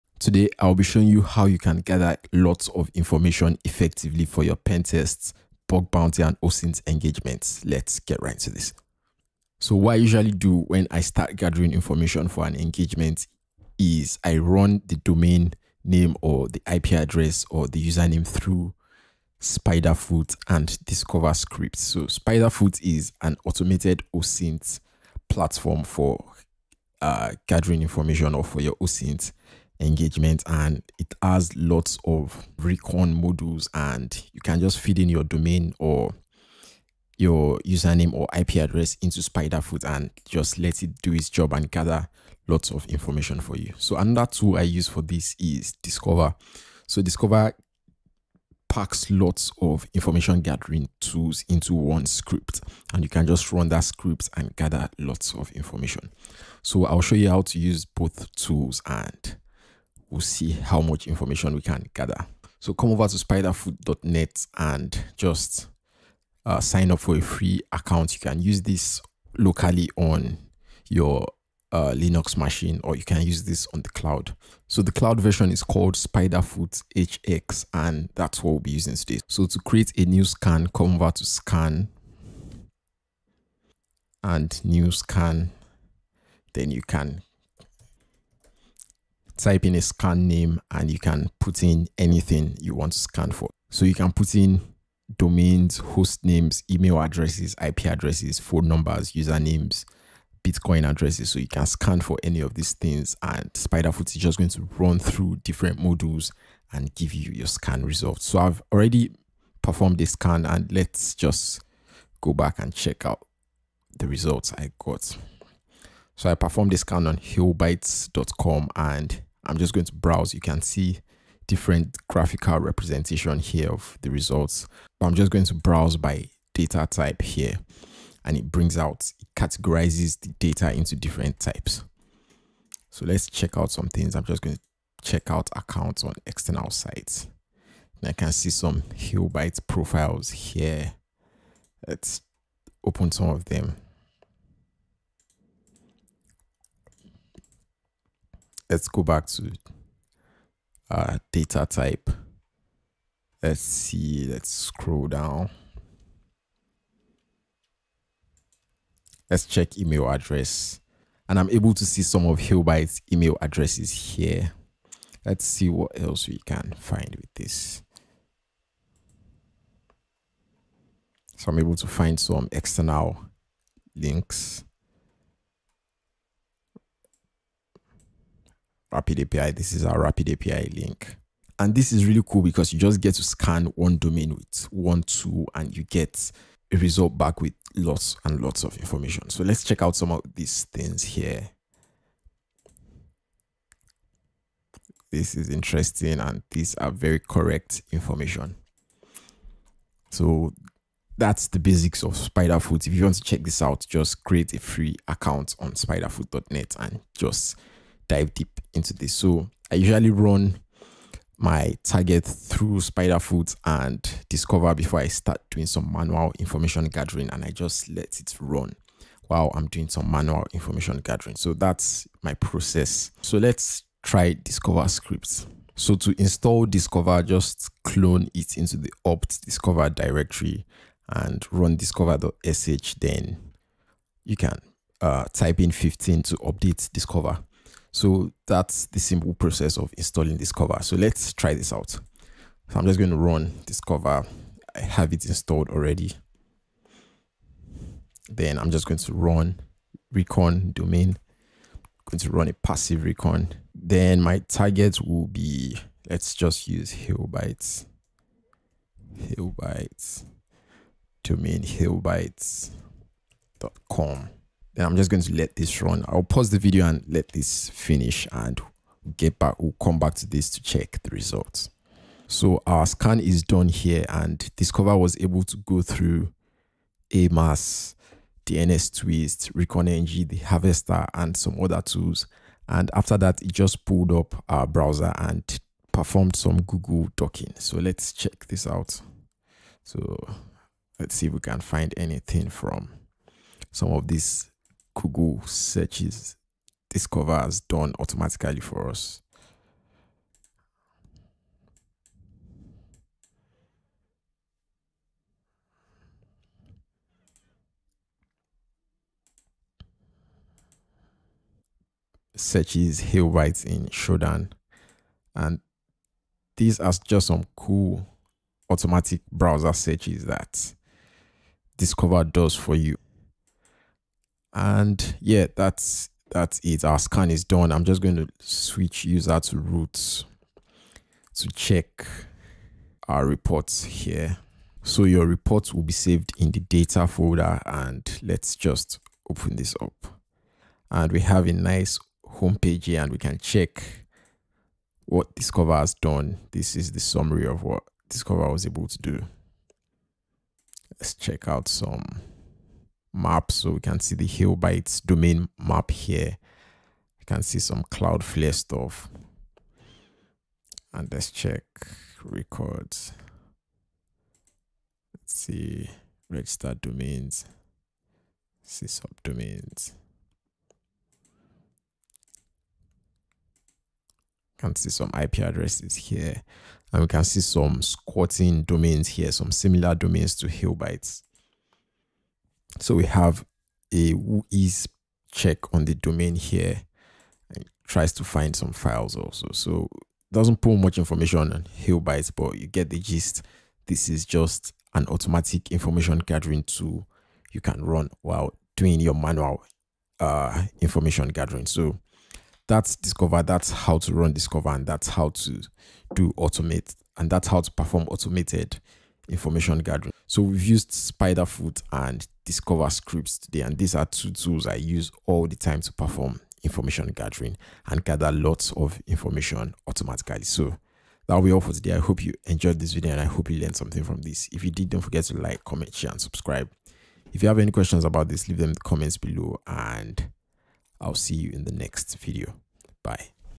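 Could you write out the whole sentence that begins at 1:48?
So I've already performed this scan and let's just go back and check out the results I got.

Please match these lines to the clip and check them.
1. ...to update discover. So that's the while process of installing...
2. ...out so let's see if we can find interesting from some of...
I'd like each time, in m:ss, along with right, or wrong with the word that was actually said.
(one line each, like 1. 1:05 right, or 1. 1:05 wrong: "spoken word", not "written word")
1. 3:56 wrong: "simple", not "while"
2. 4:48 wrong: "anything", not "interesting".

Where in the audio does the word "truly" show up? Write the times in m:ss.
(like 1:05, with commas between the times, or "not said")
not said.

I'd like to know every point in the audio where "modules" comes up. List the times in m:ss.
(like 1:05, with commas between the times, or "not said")
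0:33, 1:45.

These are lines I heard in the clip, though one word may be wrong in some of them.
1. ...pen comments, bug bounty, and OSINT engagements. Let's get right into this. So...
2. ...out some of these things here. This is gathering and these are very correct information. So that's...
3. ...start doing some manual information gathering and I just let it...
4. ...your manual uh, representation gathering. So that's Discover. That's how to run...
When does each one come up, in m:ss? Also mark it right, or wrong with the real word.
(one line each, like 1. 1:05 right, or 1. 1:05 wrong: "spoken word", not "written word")
1. 0:04 wrong: "tests", not "comments"
2. 3:09 wrong: "interesting", not "gathering"
3. 3:35 right
4. 6:38 wrong: "information", not "representation".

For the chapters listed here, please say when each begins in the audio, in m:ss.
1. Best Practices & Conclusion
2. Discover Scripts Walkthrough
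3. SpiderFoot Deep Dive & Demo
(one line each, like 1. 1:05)
1. 6:50
2. 3:45
3. 2:55.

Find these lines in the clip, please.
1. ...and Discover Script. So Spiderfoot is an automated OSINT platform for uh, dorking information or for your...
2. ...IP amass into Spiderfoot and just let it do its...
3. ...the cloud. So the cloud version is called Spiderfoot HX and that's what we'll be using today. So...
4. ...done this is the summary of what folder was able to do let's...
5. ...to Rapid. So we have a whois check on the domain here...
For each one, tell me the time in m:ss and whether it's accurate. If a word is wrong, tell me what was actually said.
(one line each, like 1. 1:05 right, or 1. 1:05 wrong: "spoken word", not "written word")
1. 0:20 wrong: "gathering", not "dorking"
2. 0:38 wrong: "address", not "amass"
3. 1:13 right
4. 5:45 wrong: "discover", not "folder"
5. 6:20 wrong: "HailBytes", not "Rapid".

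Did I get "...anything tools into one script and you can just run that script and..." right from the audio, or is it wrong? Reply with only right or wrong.
wrong.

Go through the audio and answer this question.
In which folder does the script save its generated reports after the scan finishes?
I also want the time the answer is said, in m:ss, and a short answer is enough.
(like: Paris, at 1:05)
data folder, at 5:36.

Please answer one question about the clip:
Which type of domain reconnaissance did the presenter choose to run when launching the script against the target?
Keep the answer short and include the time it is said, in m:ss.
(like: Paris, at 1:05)
passive recon, at 4:12.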